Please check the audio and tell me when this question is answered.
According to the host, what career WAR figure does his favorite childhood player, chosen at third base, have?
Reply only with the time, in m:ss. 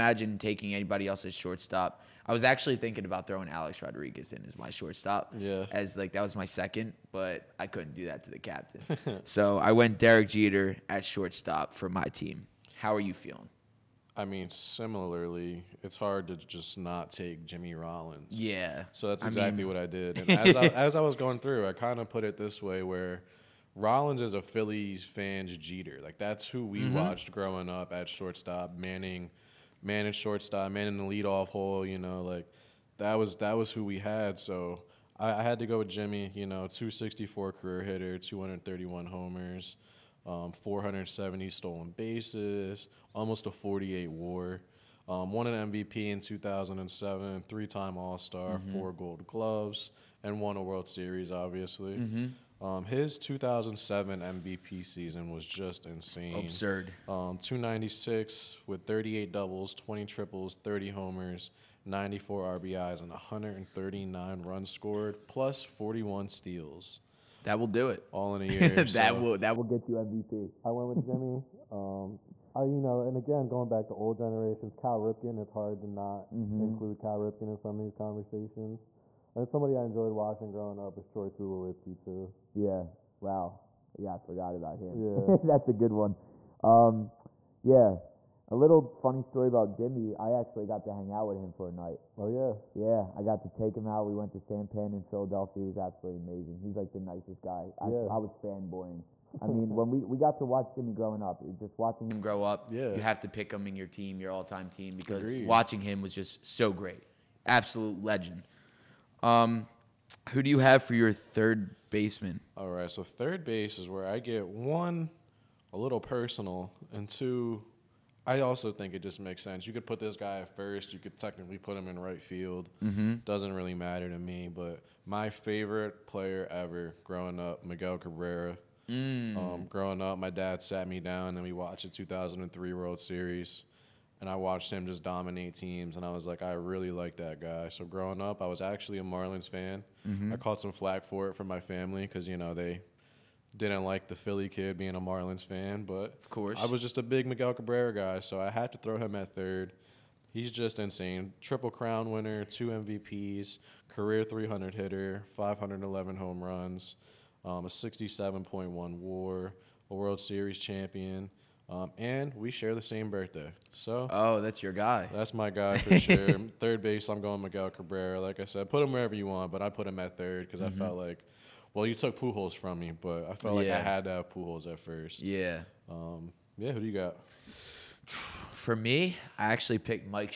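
2:37.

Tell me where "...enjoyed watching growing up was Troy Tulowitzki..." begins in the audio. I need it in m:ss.
1:19.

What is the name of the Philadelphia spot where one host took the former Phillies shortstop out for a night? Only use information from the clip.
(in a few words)
Sampan.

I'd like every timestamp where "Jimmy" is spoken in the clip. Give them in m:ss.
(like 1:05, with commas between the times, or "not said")
0:17, 0:35, 1:11, 1:29, 1:40.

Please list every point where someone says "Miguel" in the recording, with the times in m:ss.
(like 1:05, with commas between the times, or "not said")
2:07, 2:27, 2:47.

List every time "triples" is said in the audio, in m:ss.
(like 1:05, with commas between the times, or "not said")
1:00, 2:31.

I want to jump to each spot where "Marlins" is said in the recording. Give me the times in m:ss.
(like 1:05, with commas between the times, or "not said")
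2:19, 2:25.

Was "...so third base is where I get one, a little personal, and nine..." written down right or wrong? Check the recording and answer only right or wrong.
wrong.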